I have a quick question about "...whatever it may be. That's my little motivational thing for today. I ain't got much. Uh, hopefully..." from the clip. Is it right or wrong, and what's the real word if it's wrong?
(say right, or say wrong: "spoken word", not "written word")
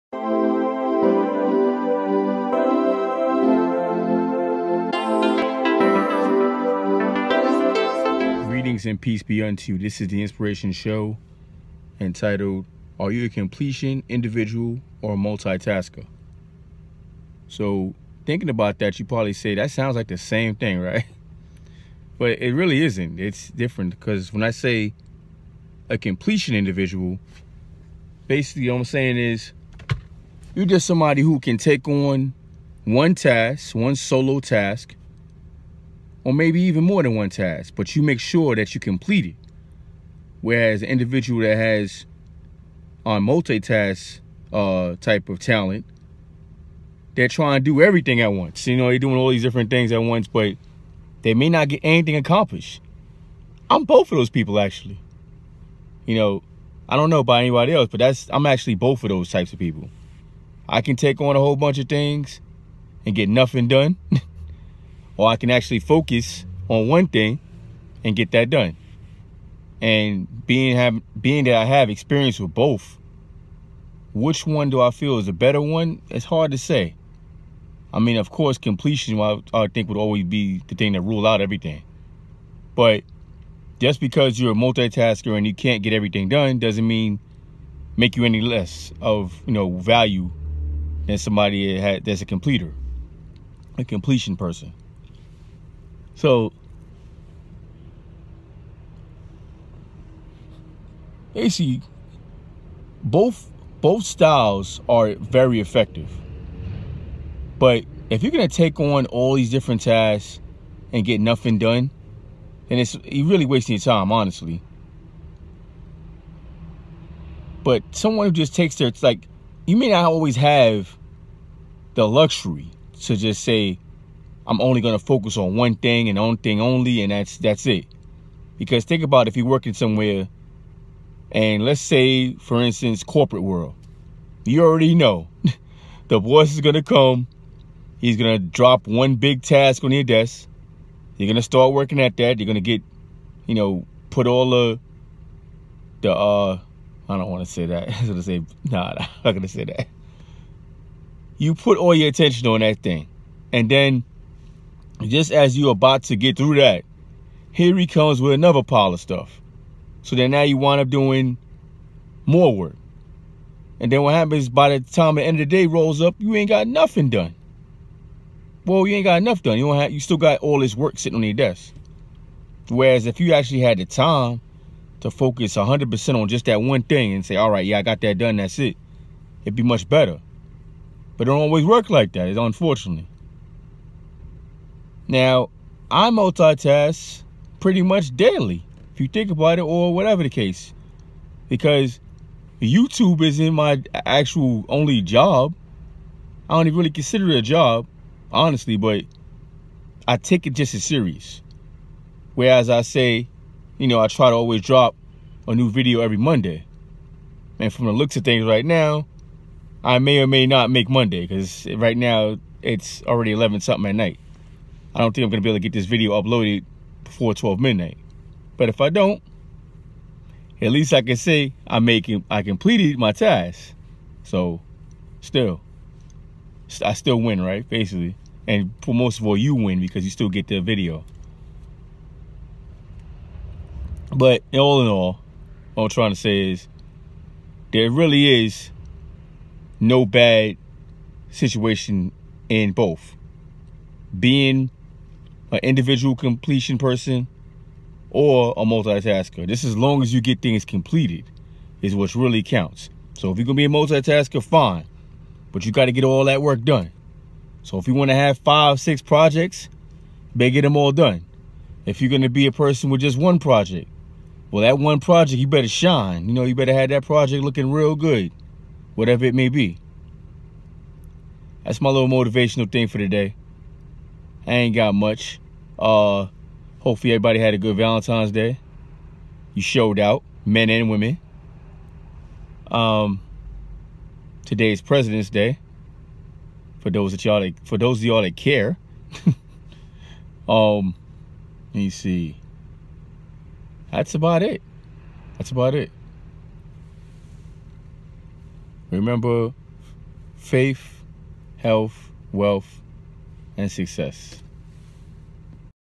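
right.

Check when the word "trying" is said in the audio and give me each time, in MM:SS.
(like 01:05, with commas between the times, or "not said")
00:47, 03:55.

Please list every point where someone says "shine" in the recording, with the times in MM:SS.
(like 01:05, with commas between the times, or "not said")
04:25.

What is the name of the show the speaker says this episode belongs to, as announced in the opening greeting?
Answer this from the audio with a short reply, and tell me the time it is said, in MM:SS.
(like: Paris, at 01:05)
Inspiration Show, at 00:10.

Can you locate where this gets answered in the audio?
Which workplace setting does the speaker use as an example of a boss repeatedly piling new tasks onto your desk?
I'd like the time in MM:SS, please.
02:13.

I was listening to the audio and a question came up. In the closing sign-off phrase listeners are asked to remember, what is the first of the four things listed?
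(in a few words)
Faith.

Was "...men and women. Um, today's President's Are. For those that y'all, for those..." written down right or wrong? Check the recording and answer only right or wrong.
wrong.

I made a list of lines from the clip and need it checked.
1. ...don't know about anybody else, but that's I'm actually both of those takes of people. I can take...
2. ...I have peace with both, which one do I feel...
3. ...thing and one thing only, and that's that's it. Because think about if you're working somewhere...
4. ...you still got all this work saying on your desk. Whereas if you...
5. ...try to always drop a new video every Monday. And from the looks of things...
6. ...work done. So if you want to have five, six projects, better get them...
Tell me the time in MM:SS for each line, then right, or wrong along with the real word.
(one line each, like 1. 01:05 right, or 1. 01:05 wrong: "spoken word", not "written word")
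1. 00:56 wrong: "types", not "takes"
2. 01:11 wrong: "experience", not "peace"
3. 02:05 right
4. 02:49 wrong: "sitting", not "saying"
5. 03:24 right
6. 04:16 right.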